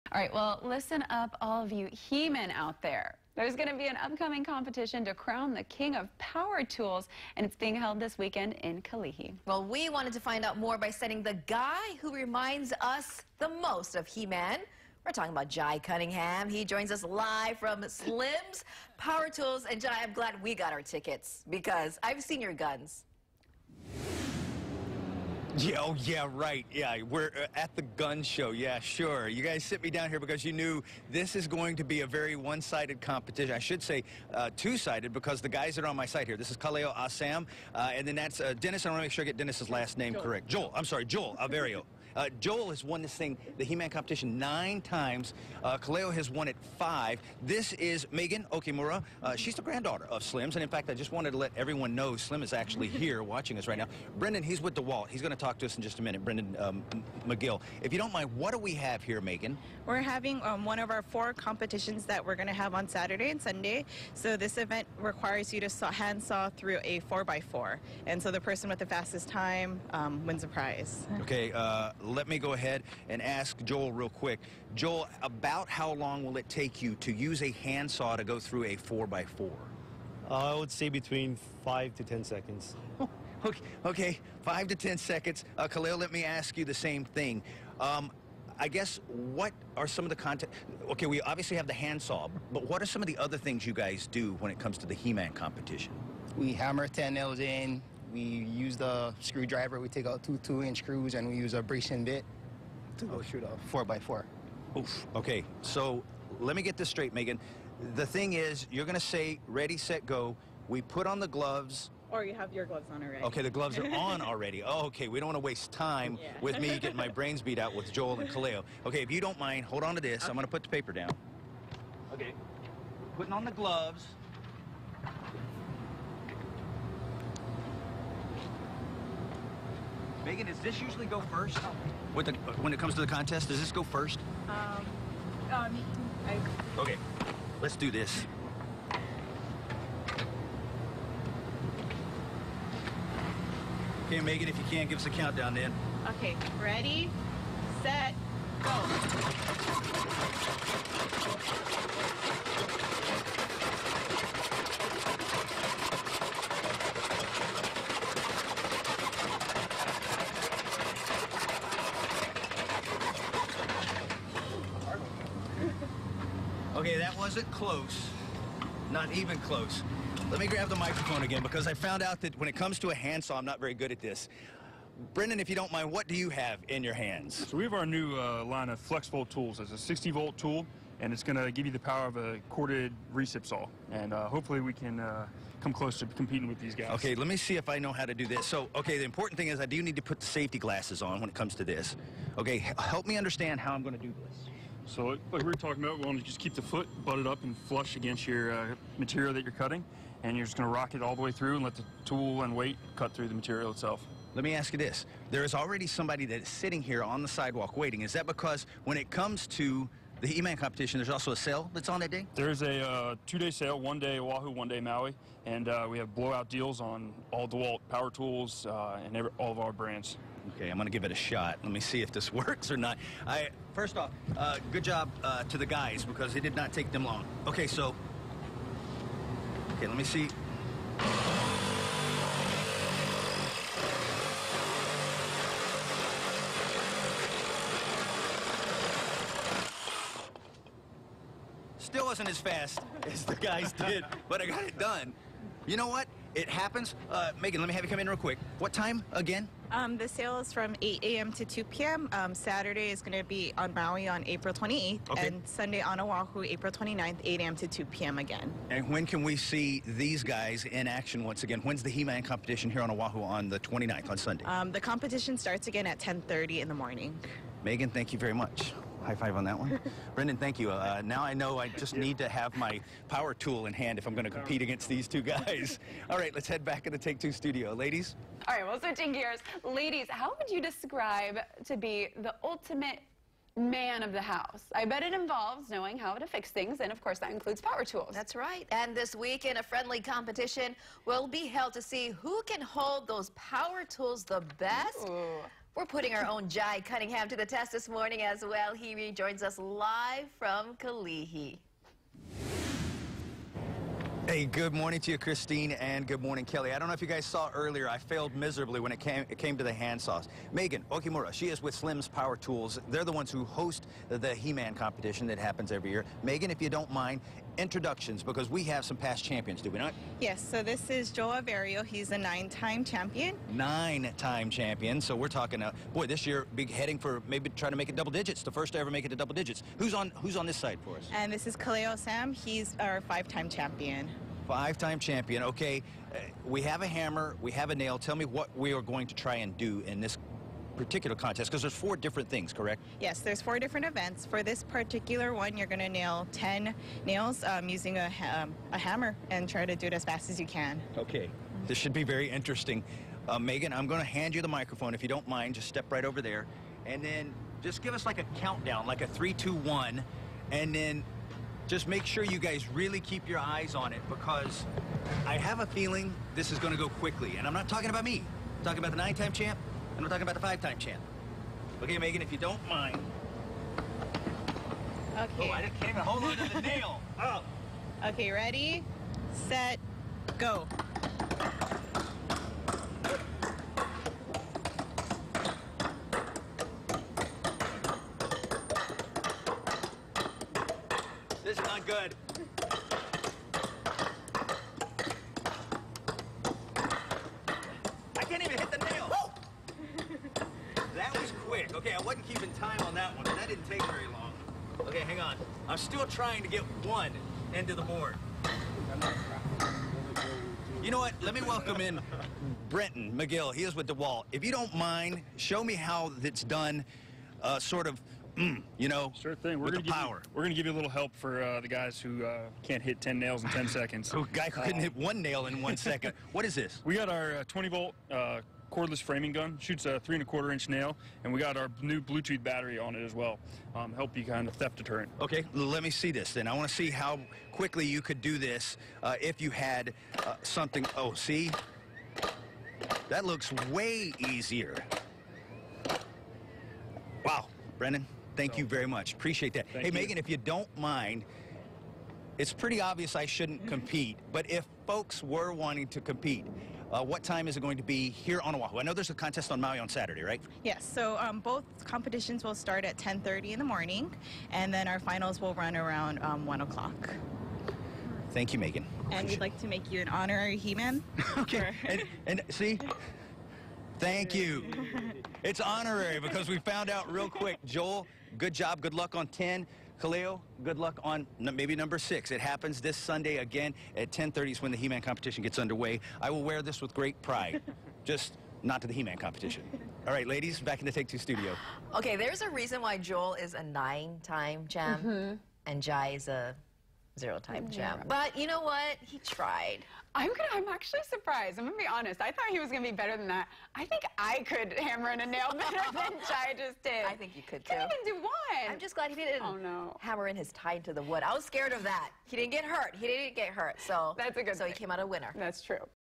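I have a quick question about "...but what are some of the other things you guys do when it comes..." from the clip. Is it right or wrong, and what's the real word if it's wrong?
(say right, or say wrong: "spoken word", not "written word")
right.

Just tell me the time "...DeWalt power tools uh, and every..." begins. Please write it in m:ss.
3:37.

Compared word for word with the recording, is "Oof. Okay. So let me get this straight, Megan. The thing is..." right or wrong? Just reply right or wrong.
right.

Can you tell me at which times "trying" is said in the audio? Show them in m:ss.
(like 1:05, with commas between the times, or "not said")
5:27, 6:46.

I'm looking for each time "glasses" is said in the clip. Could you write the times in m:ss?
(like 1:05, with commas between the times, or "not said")
3:10.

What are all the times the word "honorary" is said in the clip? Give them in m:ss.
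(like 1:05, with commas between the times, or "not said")
7:50, 7:55.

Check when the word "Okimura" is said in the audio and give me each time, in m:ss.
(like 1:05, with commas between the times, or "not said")
0:48, 5:10.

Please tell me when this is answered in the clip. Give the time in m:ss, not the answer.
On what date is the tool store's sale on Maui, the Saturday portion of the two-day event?
4:14.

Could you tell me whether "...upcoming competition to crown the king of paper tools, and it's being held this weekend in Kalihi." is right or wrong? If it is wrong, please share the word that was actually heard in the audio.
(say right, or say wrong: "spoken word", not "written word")
wrong: "power", not "paper".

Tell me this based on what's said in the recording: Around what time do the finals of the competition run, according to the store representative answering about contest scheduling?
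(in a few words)
1 o'clock.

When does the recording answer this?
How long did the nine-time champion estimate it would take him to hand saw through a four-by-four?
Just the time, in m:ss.
1:20.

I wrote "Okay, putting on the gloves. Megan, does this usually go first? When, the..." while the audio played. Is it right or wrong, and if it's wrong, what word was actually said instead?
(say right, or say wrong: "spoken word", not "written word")
right.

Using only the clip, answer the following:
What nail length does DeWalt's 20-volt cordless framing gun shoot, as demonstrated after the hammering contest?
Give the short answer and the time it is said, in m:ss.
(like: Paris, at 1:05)
3 1/4 inch, at 7:09.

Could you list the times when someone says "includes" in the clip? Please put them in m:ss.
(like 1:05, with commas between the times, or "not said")
4:47.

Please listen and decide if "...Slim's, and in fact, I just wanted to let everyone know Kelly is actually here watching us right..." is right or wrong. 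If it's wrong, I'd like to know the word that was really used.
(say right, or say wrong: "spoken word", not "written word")
wrong: "Slim", not "Kelly".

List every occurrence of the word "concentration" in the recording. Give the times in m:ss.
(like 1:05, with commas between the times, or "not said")
not said.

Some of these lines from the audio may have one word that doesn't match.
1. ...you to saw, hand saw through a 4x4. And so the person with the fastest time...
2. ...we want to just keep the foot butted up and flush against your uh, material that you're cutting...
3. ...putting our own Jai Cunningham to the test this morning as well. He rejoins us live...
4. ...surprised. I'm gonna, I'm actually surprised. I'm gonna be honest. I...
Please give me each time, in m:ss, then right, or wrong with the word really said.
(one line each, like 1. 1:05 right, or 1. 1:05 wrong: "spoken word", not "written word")
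1. 1:05 right
2. 3:15 right
3. 4:55 right
4. 8:19 wrong: "tried", not "surprised".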